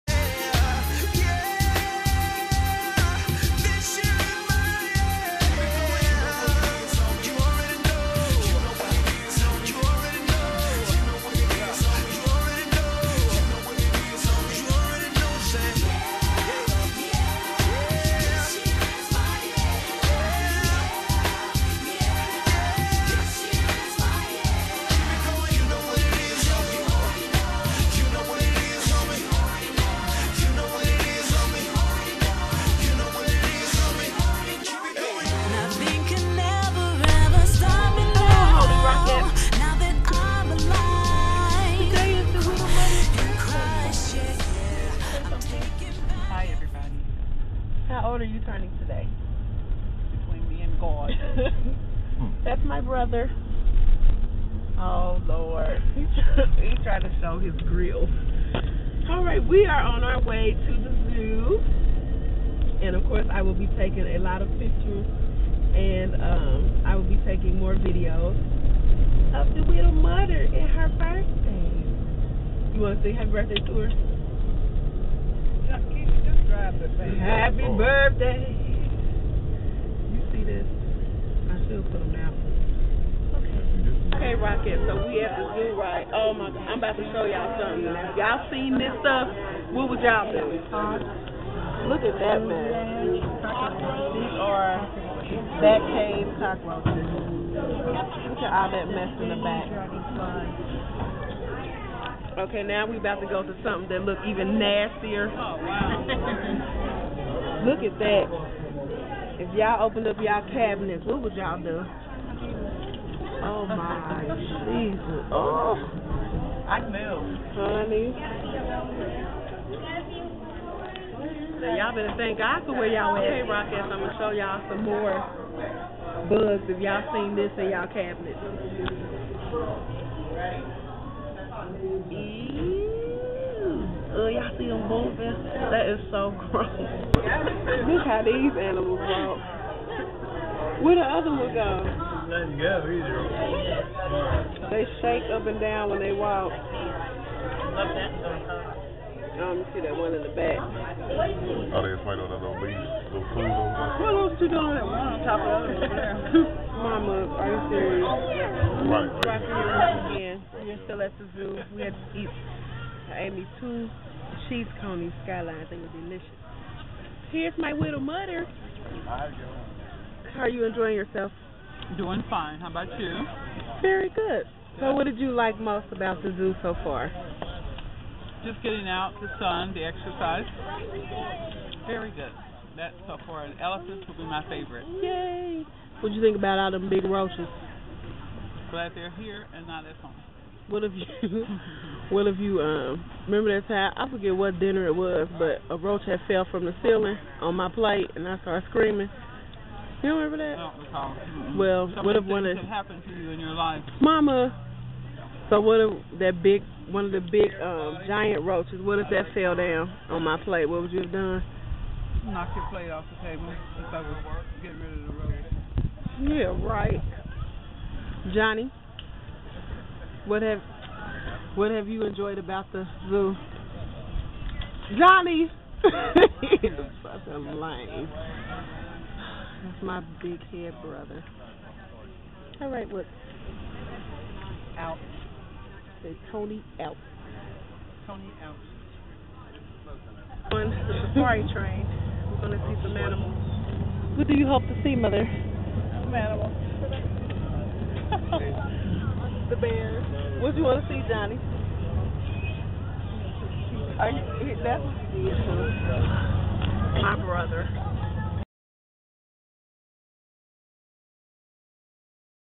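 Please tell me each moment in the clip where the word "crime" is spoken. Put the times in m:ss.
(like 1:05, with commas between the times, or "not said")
not said.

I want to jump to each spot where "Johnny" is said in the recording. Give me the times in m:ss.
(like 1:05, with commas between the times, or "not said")
3:38, 3:44, 4:11.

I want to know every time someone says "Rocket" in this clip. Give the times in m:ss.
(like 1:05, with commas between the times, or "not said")
1:24, 2:03.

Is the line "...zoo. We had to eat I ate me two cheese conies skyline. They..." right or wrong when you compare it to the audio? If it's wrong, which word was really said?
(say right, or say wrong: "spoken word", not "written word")
right.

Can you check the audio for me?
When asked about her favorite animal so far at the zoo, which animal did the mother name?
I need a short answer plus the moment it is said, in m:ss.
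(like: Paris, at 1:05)
Elephant, at 3:03.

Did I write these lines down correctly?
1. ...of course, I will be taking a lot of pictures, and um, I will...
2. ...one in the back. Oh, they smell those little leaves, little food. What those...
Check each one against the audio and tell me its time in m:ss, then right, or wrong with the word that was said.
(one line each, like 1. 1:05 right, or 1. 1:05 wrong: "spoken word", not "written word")
1. 1:02 right
2. 2:29 right.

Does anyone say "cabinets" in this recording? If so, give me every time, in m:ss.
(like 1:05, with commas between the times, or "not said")
1:50, 2:07.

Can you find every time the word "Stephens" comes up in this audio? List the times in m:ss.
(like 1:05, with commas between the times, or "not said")
not said.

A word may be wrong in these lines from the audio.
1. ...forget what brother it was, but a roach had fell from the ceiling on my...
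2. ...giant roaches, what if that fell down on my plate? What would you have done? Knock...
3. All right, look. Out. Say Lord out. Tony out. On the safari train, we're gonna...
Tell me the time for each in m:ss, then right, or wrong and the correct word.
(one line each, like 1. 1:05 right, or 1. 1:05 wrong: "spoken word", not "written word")
1. 3:14 wrong: "dinner", not "brother"
2. 3:28 right
3. 3:52 wrong: "Tony", not "Lord".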